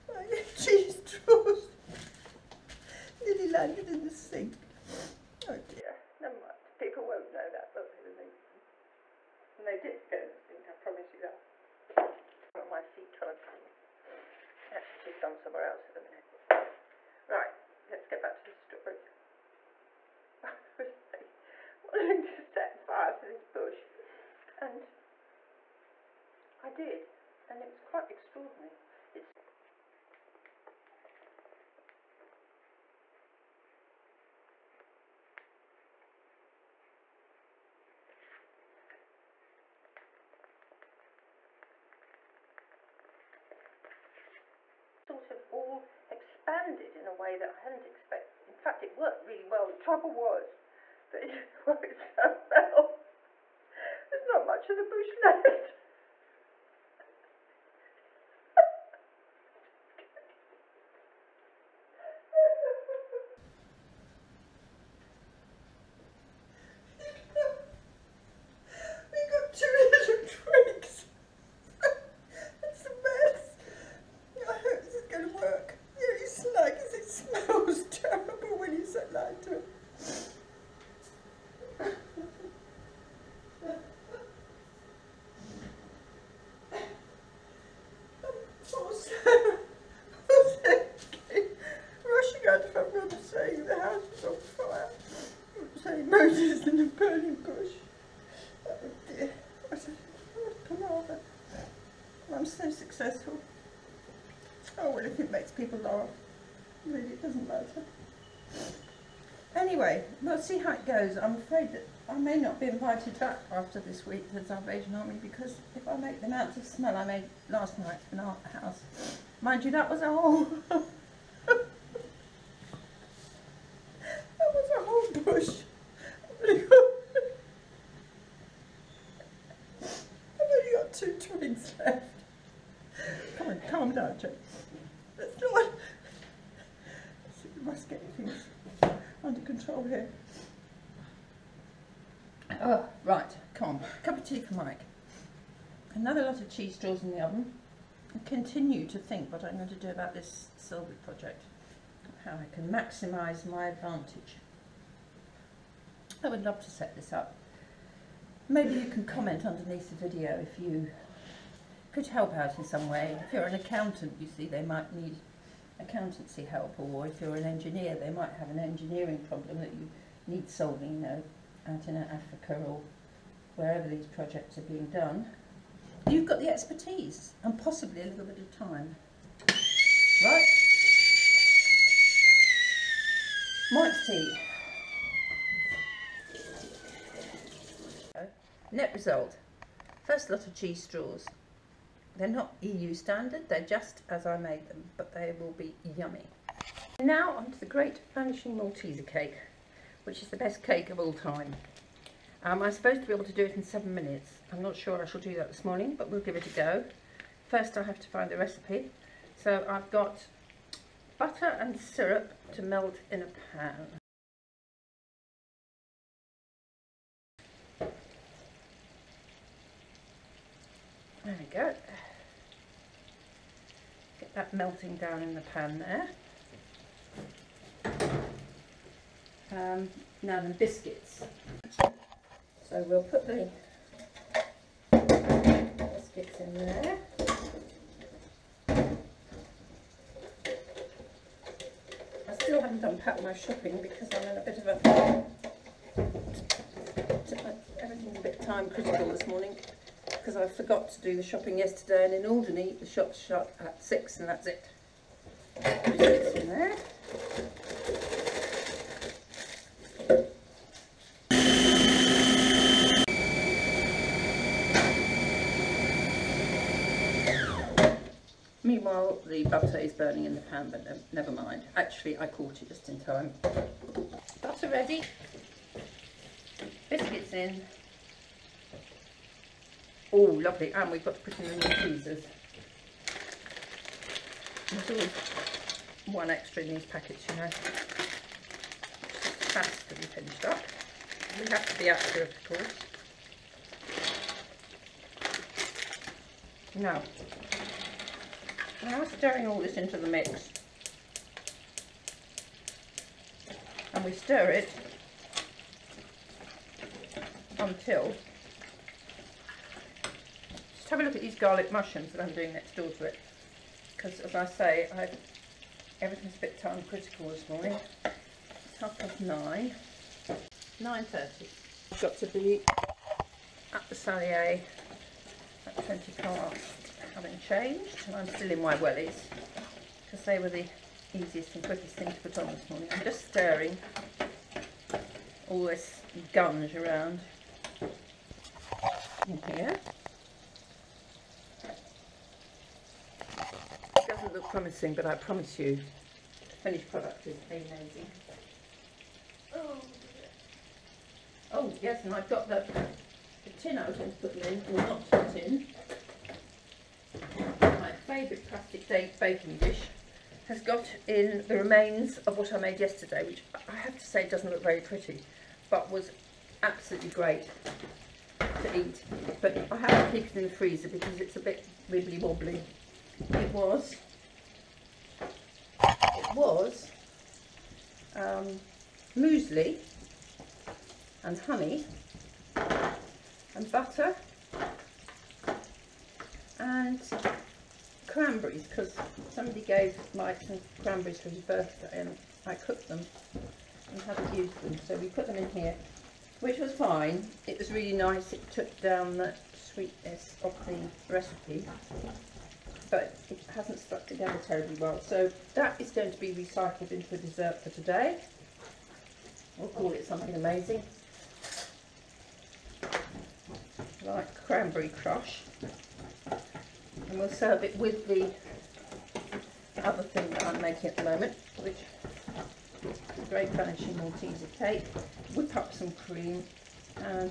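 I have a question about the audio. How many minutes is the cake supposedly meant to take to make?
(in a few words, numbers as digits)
7.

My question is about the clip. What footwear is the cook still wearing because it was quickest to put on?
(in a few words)
wellies.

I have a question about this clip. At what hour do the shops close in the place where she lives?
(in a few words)
6.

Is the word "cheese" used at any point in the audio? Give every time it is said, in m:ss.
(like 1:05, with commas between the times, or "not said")
0:00, 2:26, 3:10, 4:41.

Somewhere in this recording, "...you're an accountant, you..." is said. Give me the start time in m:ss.
2:43.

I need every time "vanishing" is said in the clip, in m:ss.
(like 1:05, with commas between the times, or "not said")
3:18, 7:03.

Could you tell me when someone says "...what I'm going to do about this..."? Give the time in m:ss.
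2:29.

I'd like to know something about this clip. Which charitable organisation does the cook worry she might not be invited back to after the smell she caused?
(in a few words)
Salvation Army.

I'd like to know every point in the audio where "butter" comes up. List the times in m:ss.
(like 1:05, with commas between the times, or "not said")
3:31, 4:29, 4:34, 6:23.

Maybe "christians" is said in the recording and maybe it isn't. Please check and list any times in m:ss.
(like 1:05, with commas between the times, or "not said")
not said.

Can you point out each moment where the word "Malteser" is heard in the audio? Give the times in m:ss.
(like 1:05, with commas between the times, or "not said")
3:18, 7:03.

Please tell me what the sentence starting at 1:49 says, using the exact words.
Anyway, we'll see how it goes.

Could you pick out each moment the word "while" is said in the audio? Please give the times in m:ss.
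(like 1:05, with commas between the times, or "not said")
0:13.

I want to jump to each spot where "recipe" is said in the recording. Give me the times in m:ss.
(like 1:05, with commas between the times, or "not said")
3:28, 6:41.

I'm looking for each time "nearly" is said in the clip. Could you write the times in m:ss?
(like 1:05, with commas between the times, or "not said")
0:03.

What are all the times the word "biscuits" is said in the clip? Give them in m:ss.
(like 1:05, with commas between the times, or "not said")
3:50, 3:54, 4:15, 4:36.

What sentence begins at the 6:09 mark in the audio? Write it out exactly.
But I have to keep it in the freezer because it's a bit wibbly wobbly.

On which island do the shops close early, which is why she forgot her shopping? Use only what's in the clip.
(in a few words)
Alderney.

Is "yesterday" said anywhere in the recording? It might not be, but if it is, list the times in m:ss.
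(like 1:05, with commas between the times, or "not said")
4:11, 6:02.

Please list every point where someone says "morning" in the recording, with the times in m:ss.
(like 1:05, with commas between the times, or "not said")
3:25, 4:09, 5:17, 5:32.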